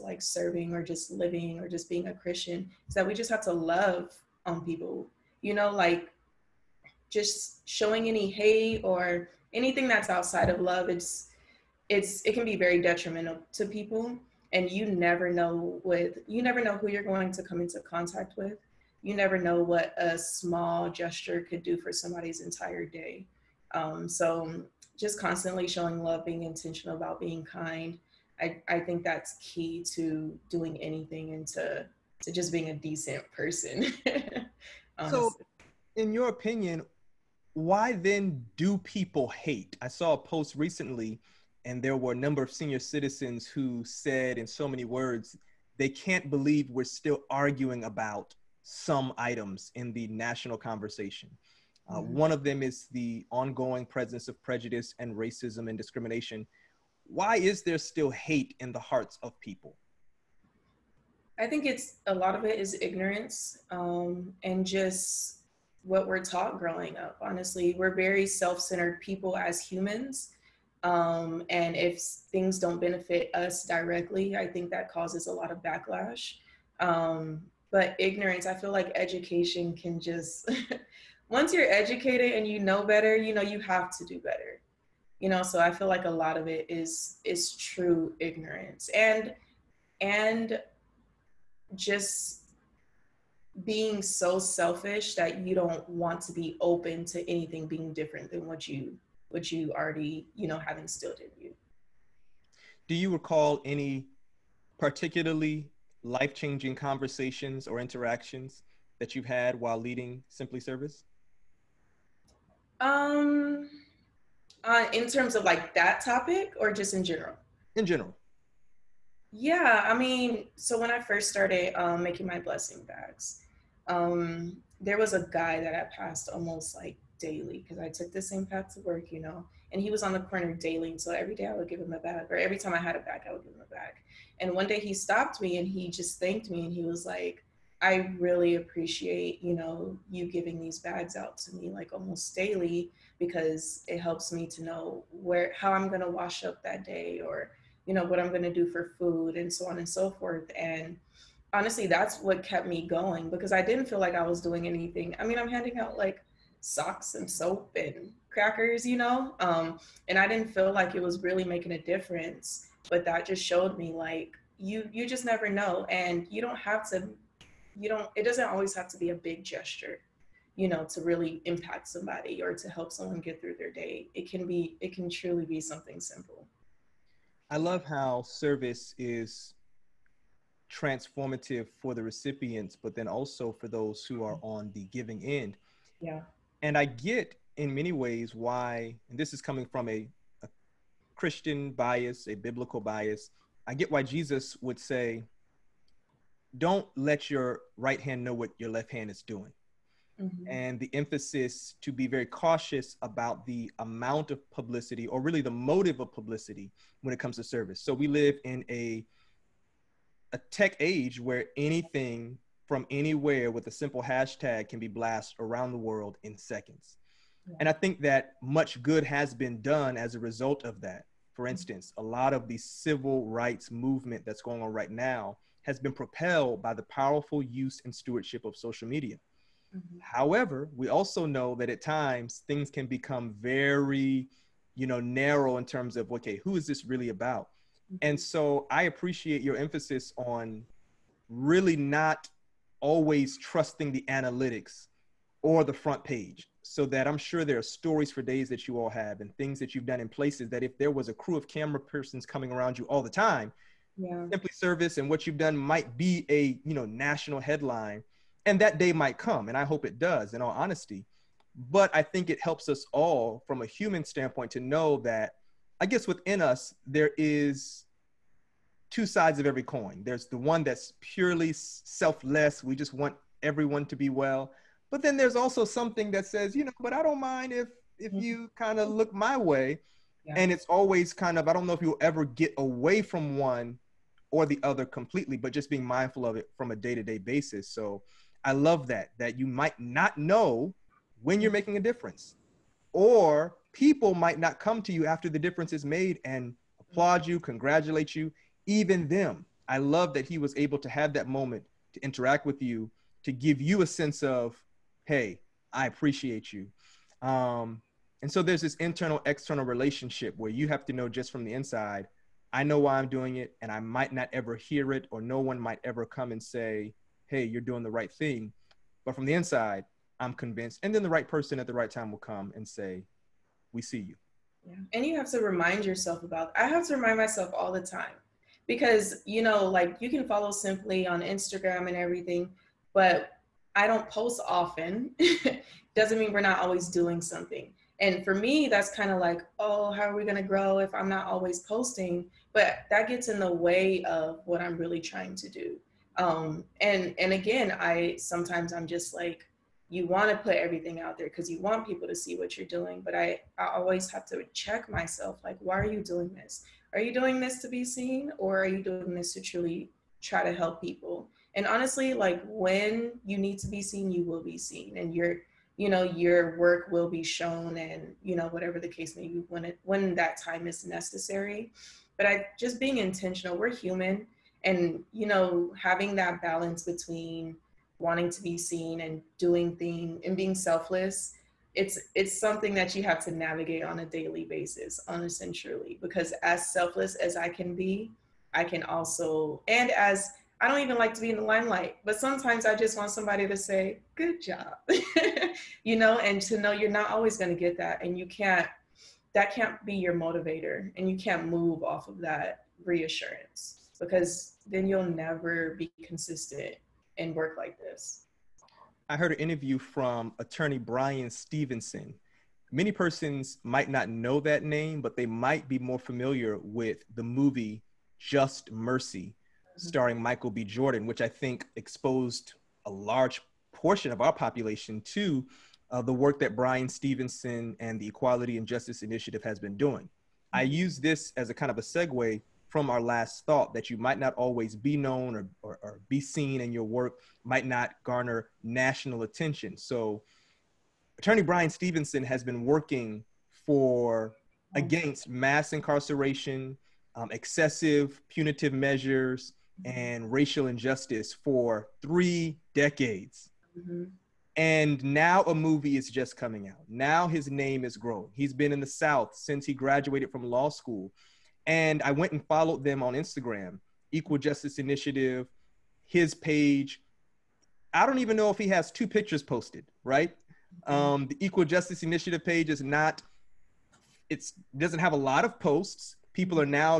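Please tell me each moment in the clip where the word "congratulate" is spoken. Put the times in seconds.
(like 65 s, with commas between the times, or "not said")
297 s.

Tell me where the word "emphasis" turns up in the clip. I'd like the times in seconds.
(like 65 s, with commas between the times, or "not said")
200 s, 239 s.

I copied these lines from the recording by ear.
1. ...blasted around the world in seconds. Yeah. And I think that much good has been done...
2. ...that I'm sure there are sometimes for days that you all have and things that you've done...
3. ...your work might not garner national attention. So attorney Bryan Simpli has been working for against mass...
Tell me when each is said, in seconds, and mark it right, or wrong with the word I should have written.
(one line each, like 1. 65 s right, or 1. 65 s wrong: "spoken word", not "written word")
1. 214 s right
2. 246 s wrong: "stories", not "sometimes"
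3. 436 s wrong: "Stevenson", not "Simpli".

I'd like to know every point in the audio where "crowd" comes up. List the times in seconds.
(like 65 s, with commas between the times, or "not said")
not said.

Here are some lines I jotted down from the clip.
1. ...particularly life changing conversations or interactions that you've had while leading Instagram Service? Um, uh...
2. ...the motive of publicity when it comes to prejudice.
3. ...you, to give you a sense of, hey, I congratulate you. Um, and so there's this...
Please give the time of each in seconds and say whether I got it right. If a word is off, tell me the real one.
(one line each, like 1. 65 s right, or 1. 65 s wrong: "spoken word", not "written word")
1. 104 s wrong: "Simpli", not "Instagram"
2. 205 s wrong: "service", not "prejudice"
3. 302 s wrong: "appreciate", not "congratulate".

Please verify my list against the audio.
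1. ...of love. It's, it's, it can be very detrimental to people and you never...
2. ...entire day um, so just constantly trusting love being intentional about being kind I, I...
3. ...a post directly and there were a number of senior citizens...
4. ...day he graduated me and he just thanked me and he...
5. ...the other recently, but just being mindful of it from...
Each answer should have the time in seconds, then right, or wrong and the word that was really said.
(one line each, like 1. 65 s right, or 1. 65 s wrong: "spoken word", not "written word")
1. 10 s right
2. 22 s wrong: "showing", not "trusting"
3. 40 s wrong: "recently", not "directly"
4. 134 s wrong: "stopped", not "graduated"
5. 284 s wrong: "completely", not "recently".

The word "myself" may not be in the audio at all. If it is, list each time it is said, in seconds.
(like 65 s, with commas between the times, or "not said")
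327 s, 354 s.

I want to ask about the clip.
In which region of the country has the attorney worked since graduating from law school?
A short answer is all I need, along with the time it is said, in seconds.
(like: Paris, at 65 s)
The South, at 458 s.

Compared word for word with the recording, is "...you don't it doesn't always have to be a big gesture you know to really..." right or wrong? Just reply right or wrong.
right.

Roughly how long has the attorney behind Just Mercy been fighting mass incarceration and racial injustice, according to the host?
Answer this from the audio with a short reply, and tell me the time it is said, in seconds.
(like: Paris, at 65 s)
Three decades, at 452 s.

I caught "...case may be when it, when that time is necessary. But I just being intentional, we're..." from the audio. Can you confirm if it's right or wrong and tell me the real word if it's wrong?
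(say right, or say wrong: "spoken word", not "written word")
right.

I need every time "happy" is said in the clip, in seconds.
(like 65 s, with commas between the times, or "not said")
not said.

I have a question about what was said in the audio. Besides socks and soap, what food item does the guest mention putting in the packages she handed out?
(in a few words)
Crackers.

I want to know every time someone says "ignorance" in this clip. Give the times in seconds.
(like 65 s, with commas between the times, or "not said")
62 s, 77 s, 88 s.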